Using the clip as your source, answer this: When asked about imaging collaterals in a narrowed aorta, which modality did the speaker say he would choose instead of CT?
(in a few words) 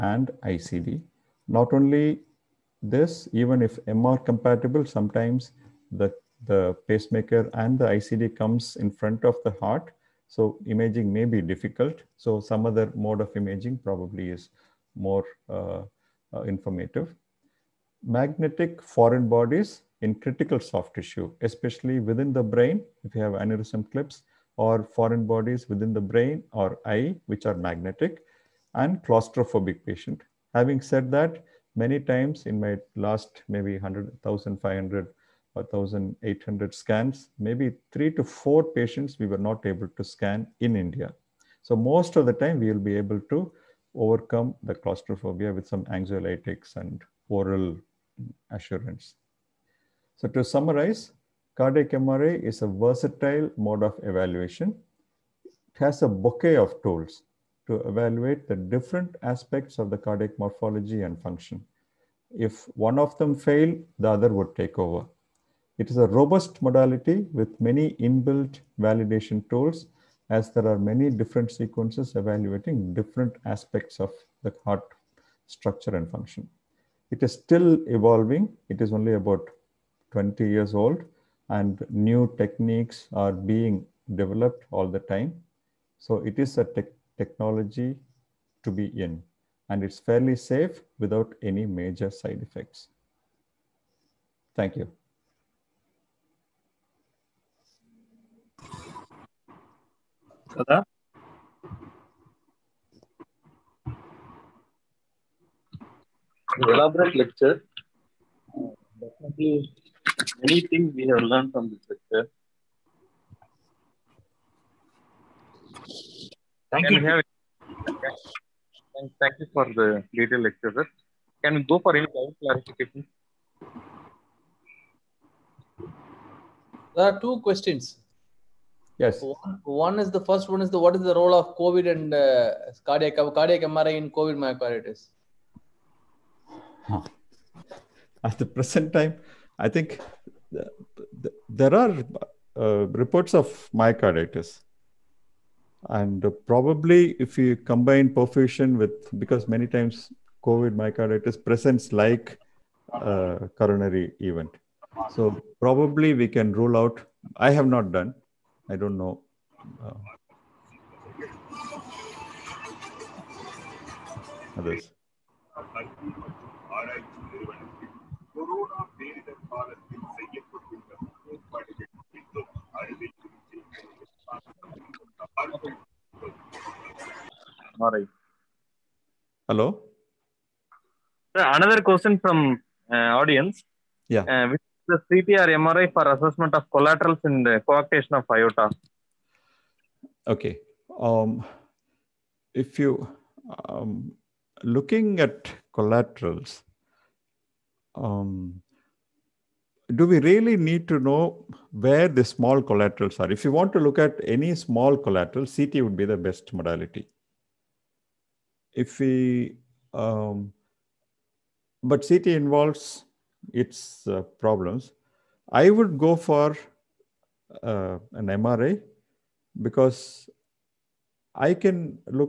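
MRA.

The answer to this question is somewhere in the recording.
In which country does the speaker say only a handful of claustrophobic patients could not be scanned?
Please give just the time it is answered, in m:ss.
0:40.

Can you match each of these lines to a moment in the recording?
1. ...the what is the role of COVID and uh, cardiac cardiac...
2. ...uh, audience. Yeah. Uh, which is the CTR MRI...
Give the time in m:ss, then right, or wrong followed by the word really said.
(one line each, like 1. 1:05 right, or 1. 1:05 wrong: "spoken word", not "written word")
1. 2:10 right
2. 3:02 right.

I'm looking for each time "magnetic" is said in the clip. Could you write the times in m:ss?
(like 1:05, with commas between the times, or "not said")
0:18, 0:27.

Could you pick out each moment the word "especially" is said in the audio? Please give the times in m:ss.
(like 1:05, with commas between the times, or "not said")
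0:21.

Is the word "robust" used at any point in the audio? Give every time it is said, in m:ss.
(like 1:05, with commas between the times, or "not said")
1:06.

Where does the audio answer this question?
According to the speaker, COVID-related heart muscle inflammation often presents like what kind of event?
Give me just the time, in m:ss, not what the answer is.
2:33.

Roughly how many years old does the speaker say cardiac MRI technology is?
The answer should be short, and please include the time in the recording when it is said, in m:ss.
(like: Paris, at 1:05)
20 years, at 1:20.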